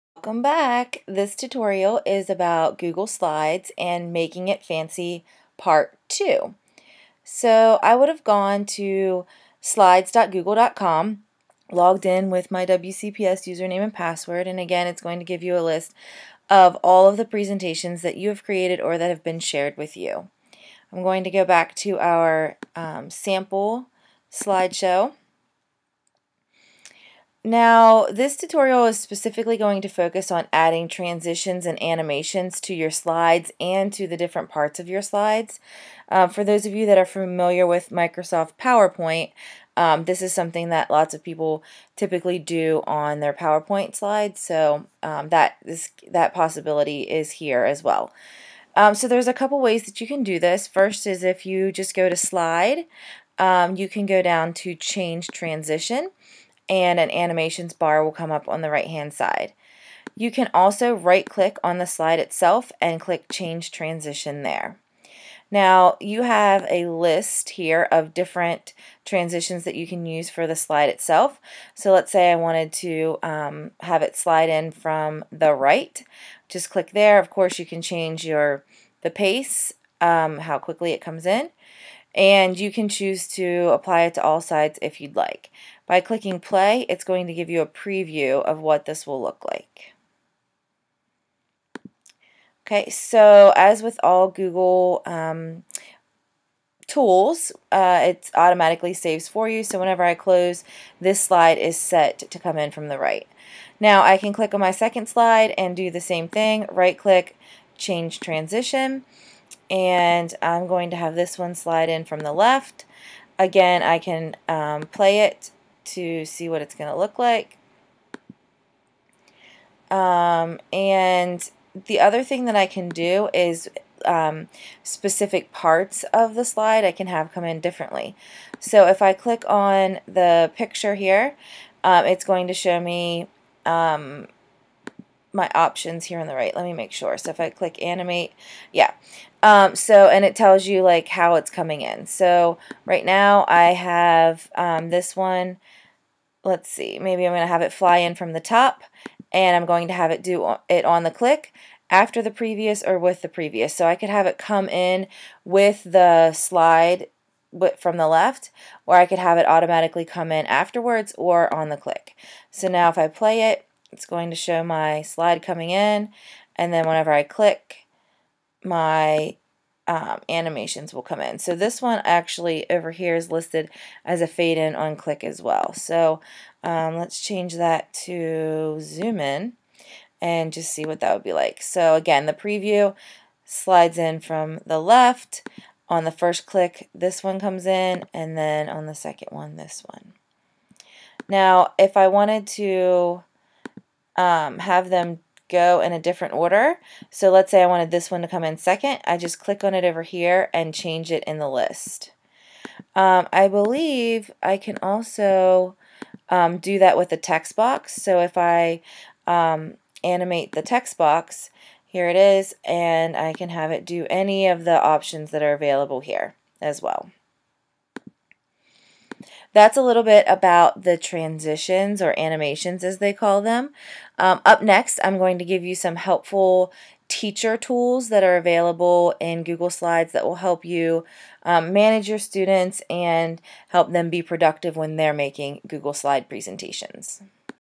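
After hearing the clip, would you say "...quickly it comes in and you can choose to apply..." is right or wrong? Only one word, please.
right.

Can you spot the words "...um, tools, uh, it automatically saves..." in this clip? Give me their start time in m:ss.
1:35.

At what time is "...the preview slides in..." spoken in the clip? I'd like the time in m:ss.
3:02.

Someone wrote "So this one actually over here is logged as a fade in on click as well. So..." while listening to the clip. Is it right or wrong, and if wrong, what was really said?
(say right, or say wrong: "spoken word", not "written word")
wrong: "listed", not "logged".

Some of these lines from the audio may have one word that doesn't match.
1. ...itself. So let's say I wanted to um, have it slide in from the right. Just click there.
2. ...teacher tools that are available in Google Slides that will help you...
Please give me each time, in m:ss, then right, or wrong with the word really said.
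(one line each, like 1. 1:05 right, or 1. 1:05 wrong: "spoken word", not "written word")
1. 1:10 right
2. 3:47 right.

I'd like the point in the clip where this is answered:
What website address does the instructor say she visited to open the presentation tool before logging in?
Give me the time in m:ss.
0:09.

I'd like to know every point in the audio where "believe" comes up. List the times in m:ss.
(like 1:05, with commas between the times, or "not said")
3:23.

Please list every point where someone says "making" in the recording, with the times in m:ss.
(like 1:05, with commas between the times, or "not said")
0:04, 3:55.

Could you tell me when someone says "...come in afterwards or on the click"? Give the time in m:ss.
2:40.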